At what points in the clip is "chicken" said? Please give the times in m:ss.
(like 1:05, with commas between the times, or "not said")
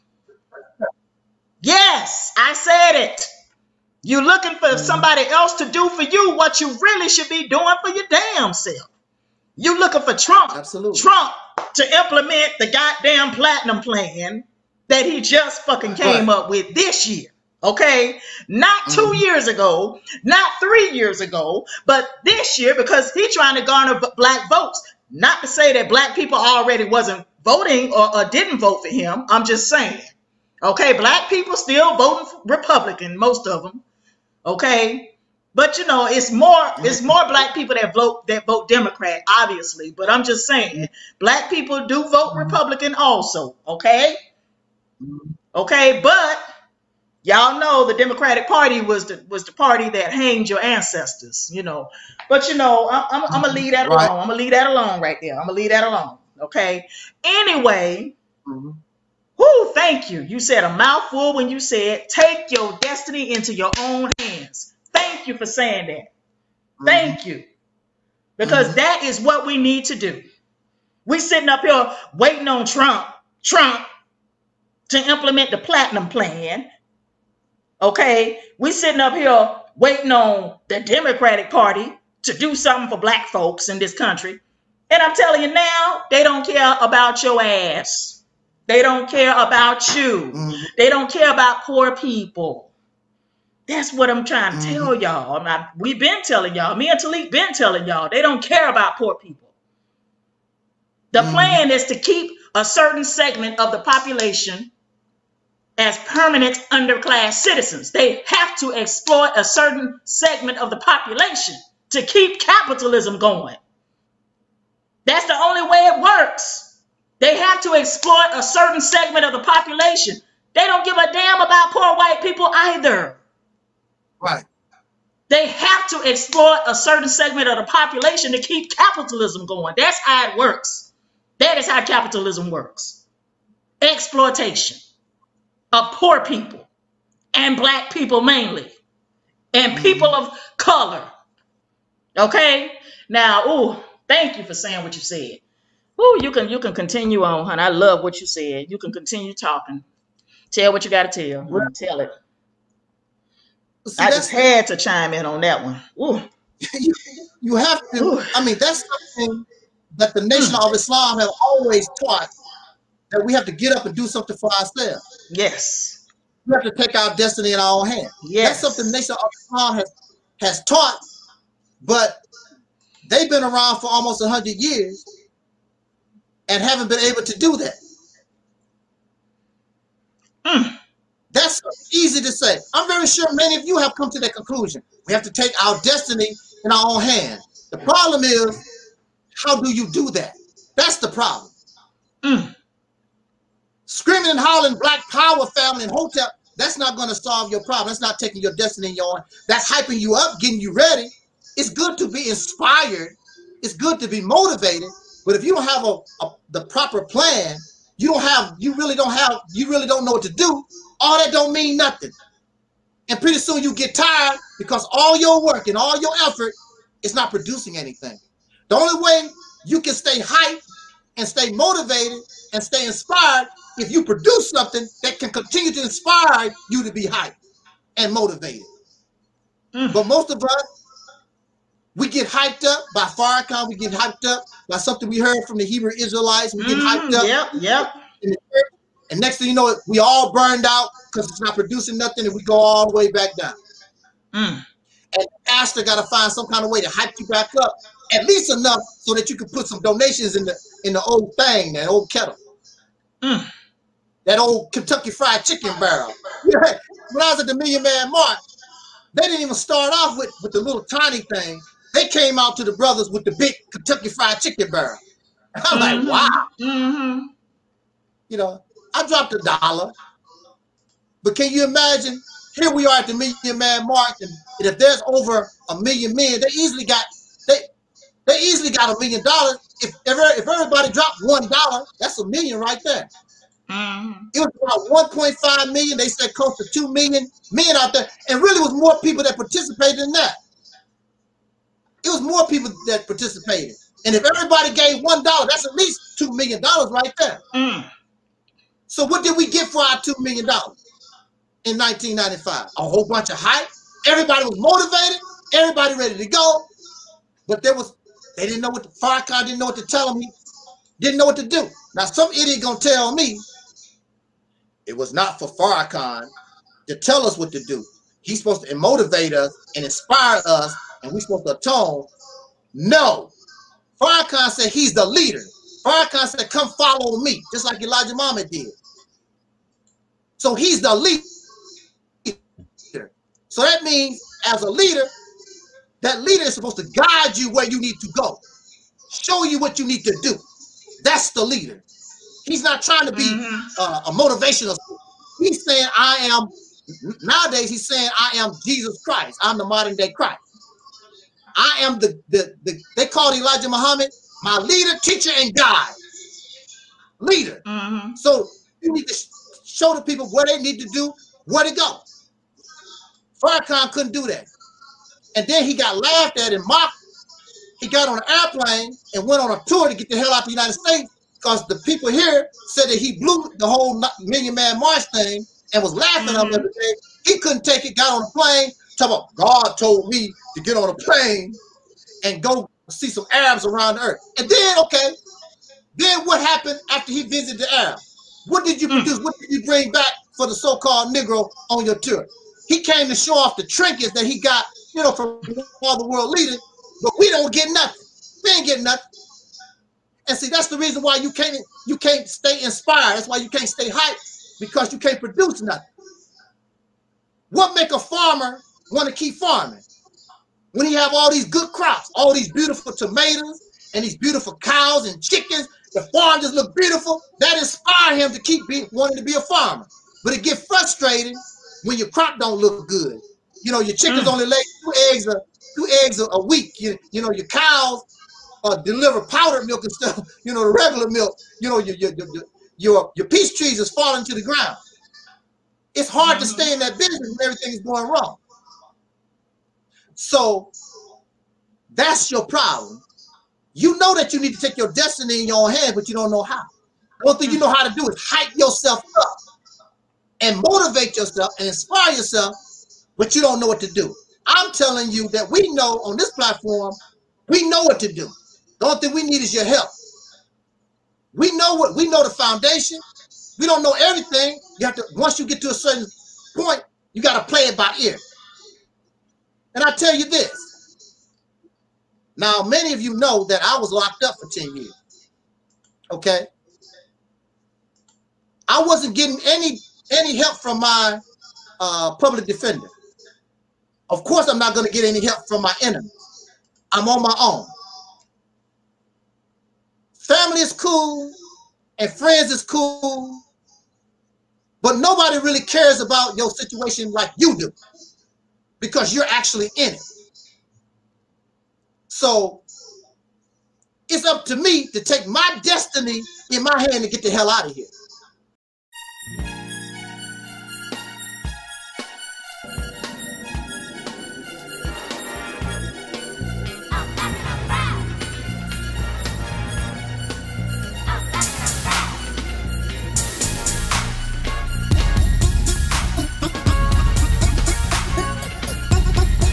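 4:15, 4:24, 6:55, 7:03.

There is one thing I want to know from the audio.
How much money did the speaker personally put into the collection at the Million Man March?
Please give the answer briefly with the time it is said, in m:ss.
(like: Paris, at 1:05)
a dollar, at 4:29.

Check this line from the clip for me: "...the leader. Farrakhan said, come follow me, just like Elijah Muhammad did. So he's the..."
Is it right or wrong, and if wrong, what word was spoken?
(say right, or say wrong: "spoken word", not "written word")
right.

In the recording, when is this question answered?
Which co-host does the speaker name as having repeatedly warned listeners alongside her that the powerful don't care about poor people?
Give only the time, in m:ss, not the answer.
1:36.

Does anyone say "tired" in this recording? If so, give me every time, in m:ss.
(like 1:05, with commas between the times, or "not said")
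3:33.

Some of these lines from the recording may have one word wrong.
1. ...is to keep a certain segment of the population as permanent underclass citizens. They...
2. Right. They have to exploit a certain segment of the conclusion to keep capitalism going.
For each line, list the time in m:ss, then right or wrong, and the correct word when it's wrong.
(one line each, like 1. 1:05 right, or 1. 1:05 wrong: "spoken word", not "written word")
1. 1:41 right
2. 2:04 wrong: "population", not "conclusion".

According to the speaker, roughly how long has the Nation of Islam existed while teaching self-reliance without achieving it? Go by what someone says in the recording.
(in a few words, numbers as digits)
almost 100 years.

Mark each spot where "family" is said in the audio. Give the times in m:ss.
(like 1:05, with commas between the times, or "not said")
3:15, 8:10.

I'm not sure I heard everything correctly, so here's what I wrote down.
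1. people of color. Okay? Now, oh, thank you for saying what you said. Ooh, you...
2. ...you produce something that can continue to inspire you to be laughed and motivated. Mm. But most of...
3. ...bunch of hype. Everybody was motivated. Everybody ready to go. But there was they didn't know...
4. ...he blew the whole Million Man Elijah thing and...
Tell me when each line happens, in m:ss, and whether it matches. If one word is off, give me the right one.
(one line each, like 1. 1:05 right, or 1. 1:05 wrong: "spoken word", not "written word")
1. 2:19 right
2. 3:43 wrong: "hyped", not "laughed"
3. 5:03 right
4. 6:12 wrong: "March", not "Elijah".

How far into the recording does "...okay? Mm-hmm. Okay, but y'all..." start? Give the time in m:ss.
0:43.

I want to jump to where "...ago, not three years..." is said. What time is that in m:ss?
0:19.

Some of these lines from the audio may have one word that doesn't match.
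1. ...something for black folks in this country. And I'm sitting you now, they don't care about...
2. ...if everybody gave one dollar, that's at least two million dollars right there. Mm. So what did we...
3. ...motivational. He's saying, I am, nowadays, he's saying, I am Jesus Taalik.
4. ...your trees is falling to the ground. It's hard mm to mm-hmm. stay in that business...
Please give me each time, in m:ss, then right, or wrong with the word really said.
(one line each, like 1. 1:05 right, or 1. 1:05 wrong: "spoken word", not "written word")
1. 1:22 wrong: "telling", not "sitting"
2. 4:54 right
3. 5:44 wrong: "Christ", not "Taalik"
4. 7:13 right.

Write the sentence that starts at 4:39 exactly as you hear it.
If ever if everybody dropped one dollar, that's a million right there.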